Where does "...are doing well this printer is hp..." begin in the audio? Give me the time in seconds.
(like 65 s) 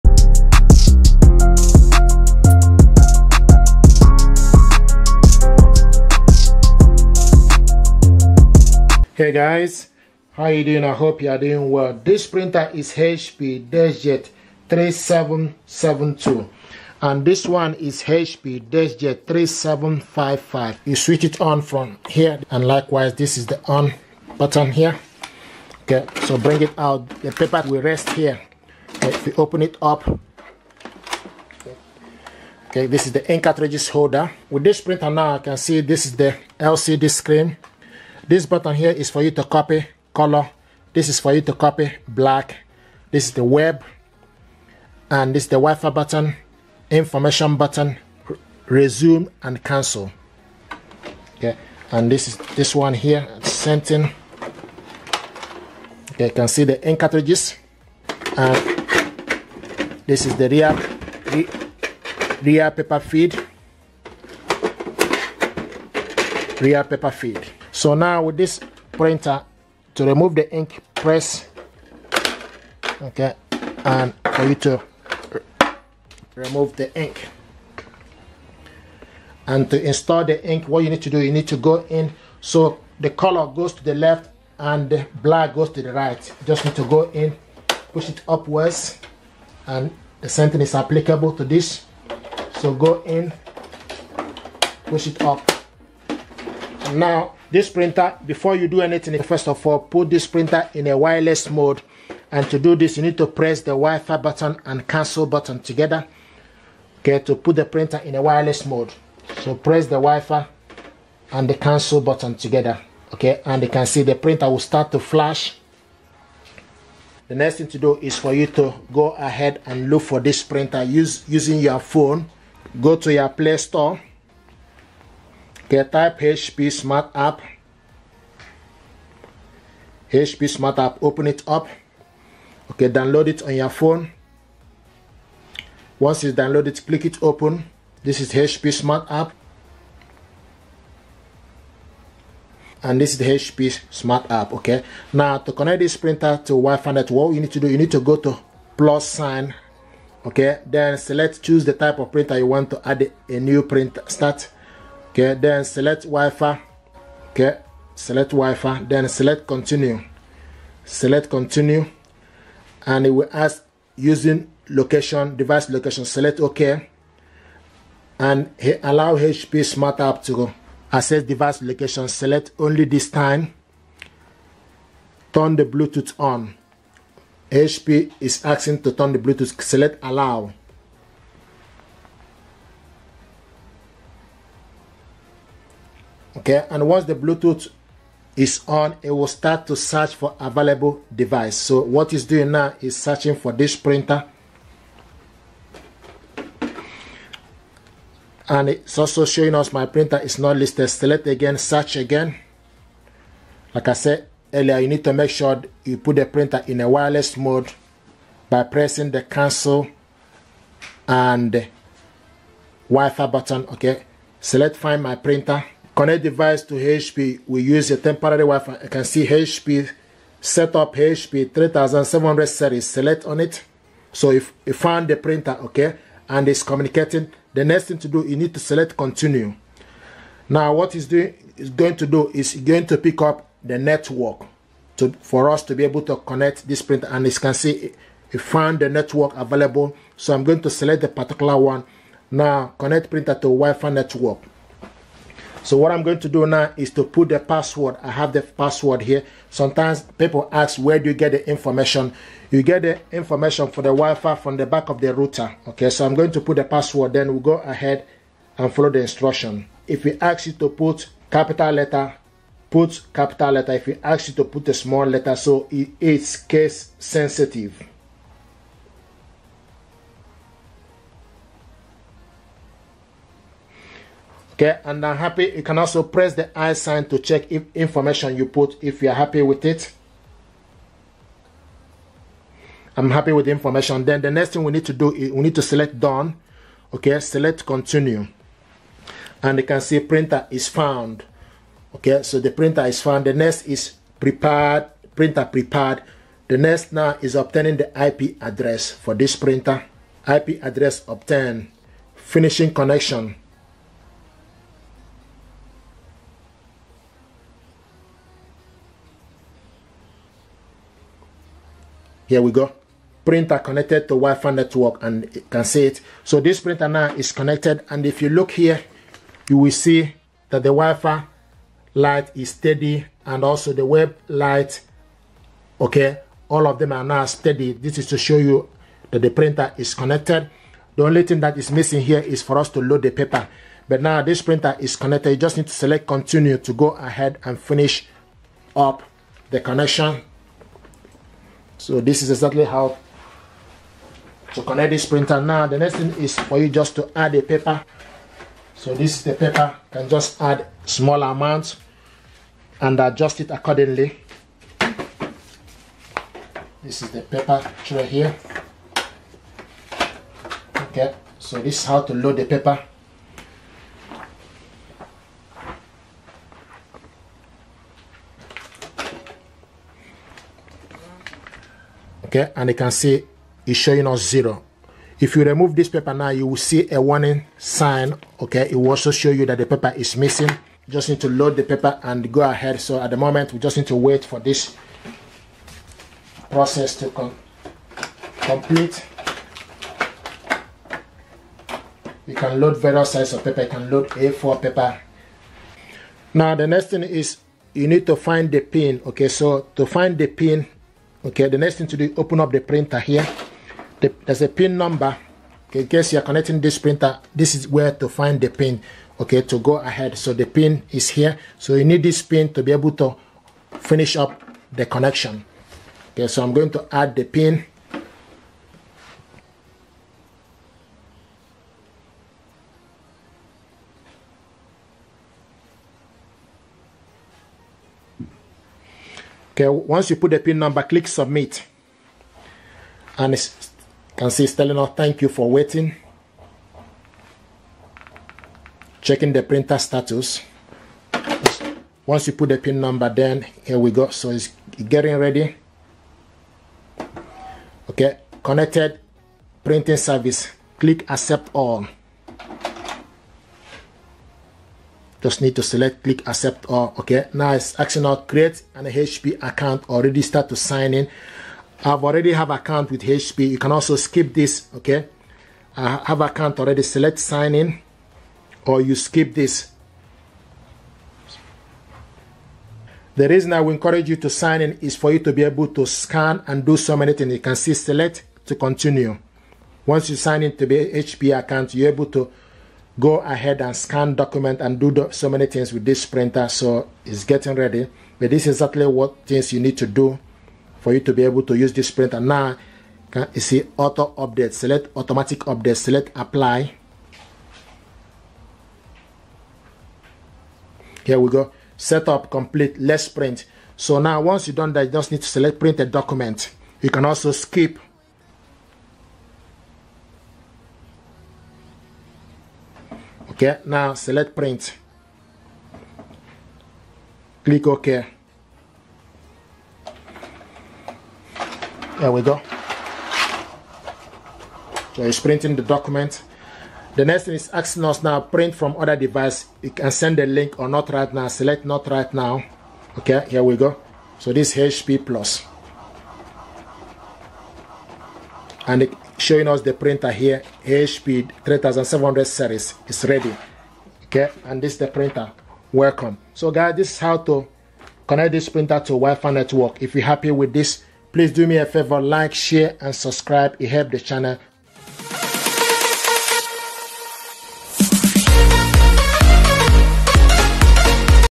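11 s.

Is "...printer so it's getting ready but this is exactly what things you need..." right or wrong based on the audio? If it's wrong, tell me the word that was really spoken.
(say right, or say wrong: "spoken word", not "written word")
right.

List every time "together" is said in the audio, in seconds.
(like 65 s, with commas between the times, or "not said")
105 s, 112 s.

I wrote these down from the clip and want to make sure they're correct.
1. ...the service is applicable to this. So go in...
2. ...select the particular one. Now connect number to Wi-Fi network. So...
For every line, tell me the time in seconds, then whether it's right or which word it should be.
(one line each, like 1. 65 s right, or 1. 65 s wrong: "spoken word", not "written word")
1. 90 s wrong: "sentence", not "service"
2. 240 s wrong: "printer", not "number".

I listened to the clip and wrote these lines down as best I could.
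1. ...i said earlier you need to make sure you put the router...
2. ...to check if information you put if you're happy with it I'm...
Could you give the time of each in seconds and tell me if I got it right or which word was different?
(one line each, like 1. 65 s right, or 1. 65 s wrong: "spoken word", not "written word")
1. 203 s wrong: "printer", not "router"
2. 277 s right.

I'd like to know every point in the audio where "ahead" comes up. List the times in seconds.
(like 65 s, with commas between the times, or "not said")
119 s, 257 s, 336 s, 382 s, 409 s, 483 s.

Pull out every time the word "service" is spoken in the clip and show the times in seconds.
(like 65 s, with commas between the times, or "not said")
449 s.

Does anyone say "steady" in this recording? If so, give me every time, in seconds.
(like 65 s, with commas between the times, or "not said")
322 s, 327 s.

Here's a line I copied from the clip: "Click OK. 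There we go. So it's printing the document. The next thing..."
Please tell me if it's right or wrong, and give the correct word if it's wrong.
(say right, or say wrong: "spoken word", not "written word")
right.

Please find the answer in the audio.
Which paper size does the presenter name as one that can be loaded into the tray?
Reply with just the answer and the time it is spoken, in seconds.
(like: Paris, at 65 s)
A4, at 394 s.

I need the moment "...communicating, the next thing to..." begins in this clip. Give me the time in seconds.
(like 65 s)
226 s.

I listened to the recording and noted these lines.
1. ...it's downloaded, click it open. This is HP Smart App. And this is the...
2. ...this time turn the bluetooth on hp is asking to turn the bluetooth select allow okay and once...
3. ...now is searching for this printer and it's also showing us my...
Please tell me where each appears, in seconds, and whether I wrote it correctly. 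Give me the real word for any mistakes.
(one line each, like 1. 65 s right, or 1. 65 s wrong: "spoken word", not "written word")
1. 136 s right
2. 172 s right
3. 192 s right.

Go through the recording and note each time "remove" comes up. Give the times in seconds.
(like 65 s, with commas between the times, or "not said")
70 s, 76 s, 375 s.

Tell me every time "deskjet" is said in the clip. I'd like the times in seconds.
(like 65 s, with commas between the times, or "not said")
13 s, 18 s.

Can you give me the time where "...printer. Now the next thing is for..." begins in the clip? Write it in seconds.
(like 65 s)
345 s.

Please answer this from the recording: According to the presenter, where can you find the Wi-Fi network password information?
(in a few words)
Back of the router.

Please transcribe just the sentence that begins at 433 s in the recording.
And it can see it's telling us thank you for waiting.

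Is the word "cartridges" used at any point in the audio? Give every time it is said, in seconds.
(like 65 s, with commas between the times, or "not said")
33 s, 56 s.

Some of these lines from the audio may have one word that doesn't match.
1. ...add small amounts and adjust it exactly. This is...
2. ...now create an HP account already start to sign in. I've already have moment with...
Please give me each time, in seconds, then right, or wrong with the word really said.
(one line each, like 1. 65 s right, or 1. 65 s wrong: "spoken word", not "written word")
1. 350 s wrong: "accordingly", not "exactly"
2. 458 s wrong: "account", not "moment".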